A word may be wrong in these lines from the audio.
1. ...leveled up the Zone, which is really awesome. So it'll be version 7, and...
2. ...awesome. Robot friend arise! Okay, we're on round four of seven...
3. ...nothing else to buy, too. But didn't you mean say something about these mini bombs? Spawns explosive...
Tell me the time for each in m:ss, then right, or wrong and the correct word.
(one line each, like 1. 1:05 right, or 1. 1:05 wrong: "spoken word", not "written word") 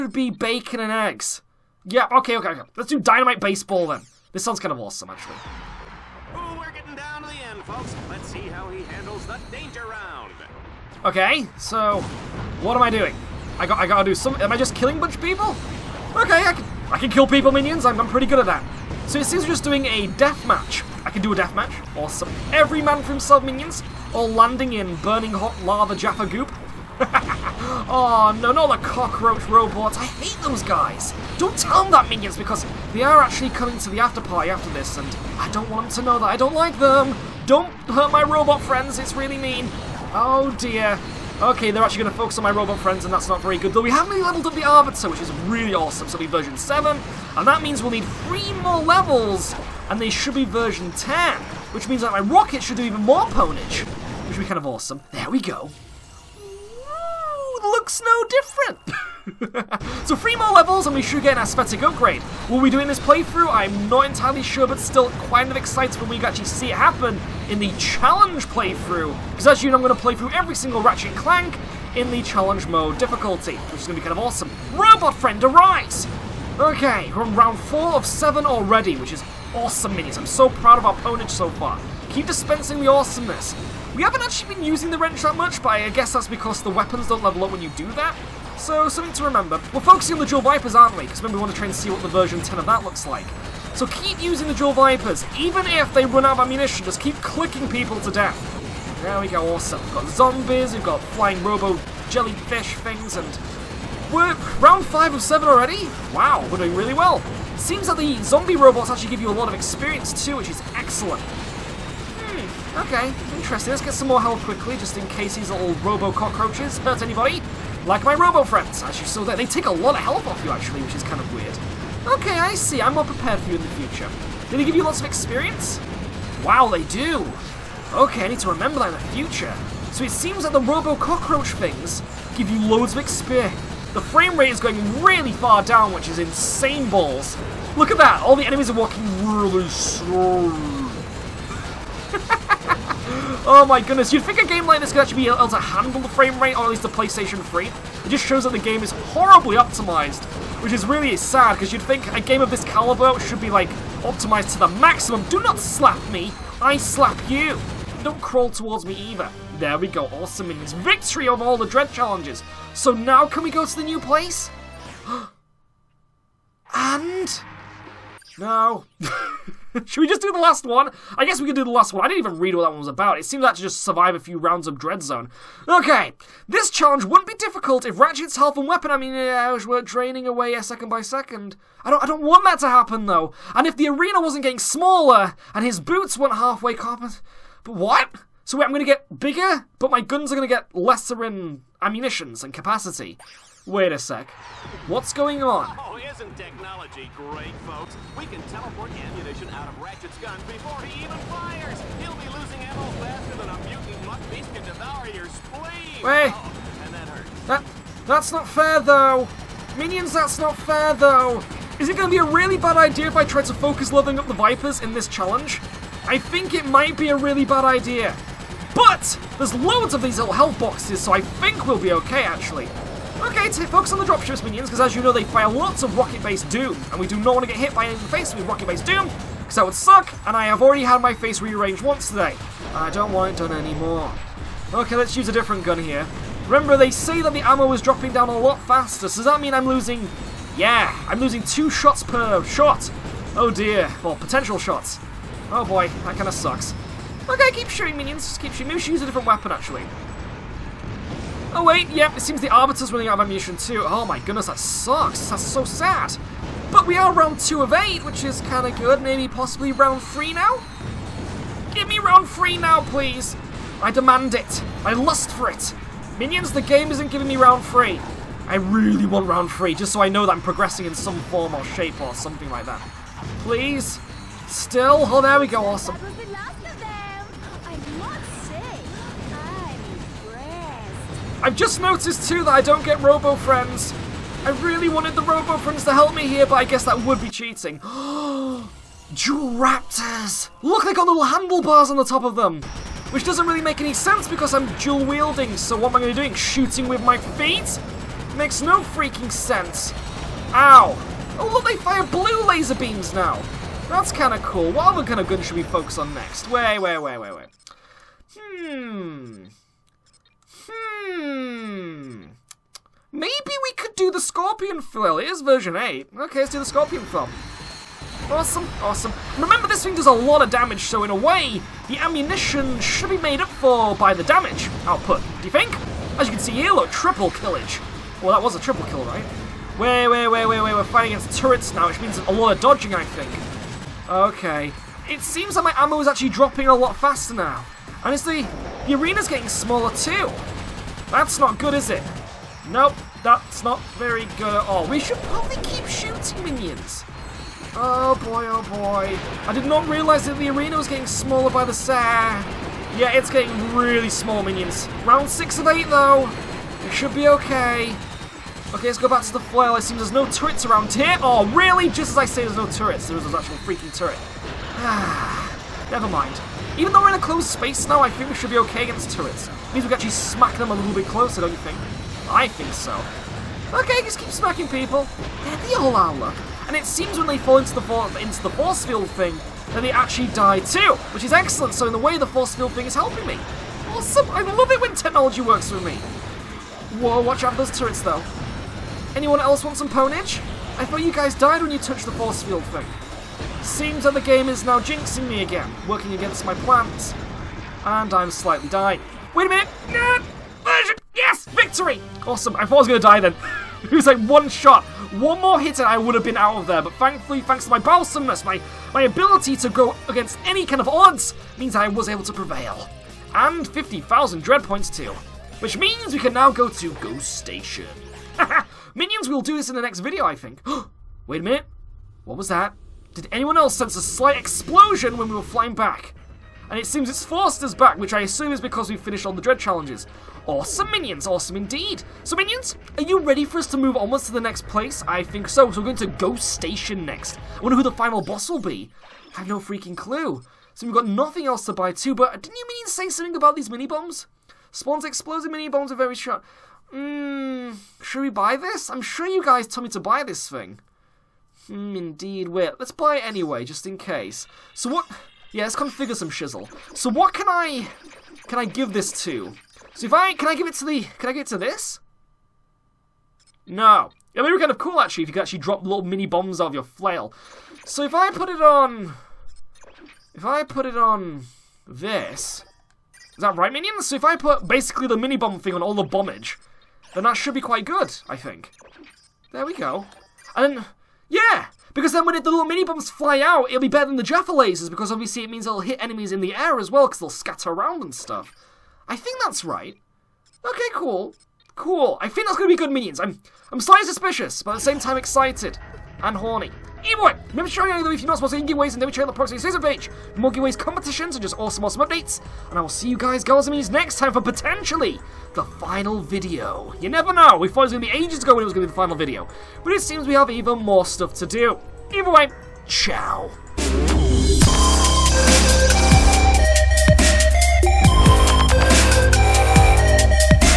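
1. 0:44 wrong: "Arbiter", not "Zone"
2. 1:14 right
3. 7:21 right.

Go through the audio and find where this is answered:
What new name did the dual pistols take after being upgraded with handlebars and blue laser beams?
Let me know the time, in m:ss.
4:47.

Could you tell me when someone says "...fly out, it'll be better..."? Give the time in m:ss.
8:03.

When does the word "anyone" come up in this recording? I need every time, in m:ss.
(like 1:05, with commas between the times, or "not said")
6:29, 7:03.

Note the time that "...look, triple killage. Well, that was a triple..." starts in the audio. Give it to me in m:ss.
5:26.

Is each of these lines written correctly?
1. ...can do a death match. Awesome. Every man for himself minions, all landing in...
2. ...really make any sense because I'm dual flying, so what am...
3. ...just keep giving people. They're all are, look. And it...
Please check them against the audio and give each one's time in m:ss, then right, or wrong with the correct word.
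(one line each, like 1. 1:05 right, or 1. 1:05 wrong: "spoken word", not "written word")
1. 0:21 right
2. 4:53 wrong: "wielding", not "flying"
3. 6:14 wrong: "smacking", not "giving".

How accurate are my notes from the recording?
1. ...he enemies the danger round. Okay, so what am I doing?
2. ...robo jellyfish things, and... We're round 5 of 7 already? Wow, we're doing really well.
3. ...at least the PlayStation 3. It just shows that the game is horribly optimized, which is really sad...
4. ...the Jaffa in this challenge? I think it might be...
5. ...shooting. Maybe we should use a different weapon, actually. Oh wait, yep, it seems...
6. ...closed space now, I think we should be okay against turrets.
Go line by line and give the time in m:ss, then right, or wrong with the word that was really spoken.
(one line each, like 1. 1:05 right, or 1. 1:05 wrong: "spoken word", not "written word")
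1. 0:08 wrong: "handles", not "enemies"
2. 1:41 right
3. 2:26 right
4. 3:34 wrong: "Vipers", not "Jaffa"
5. 4:08 right
6. 6:07 right.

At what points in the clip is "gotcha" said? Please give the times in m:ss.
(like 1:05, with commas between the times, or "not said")
not said.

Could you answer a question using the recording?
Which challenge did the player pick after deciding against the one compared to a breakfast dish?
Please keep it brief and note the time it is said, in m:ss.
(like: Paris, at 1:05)
Dynamite Baseball, at 0:02.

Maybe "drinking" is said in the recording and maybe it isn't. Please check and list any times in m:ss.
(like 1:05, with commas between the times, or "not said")
not said.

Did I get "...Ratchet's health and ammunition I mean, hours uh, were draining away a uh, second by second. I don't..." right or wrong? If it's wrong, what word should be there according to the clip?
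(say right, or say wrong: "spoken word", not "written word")
wrong: "weapon", not "ammunition".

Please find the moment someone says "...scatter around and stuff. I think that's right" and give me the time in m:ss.
8:07.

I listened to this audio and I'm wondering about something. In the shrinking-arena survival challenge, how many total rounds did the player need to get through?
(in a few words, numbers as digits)
8.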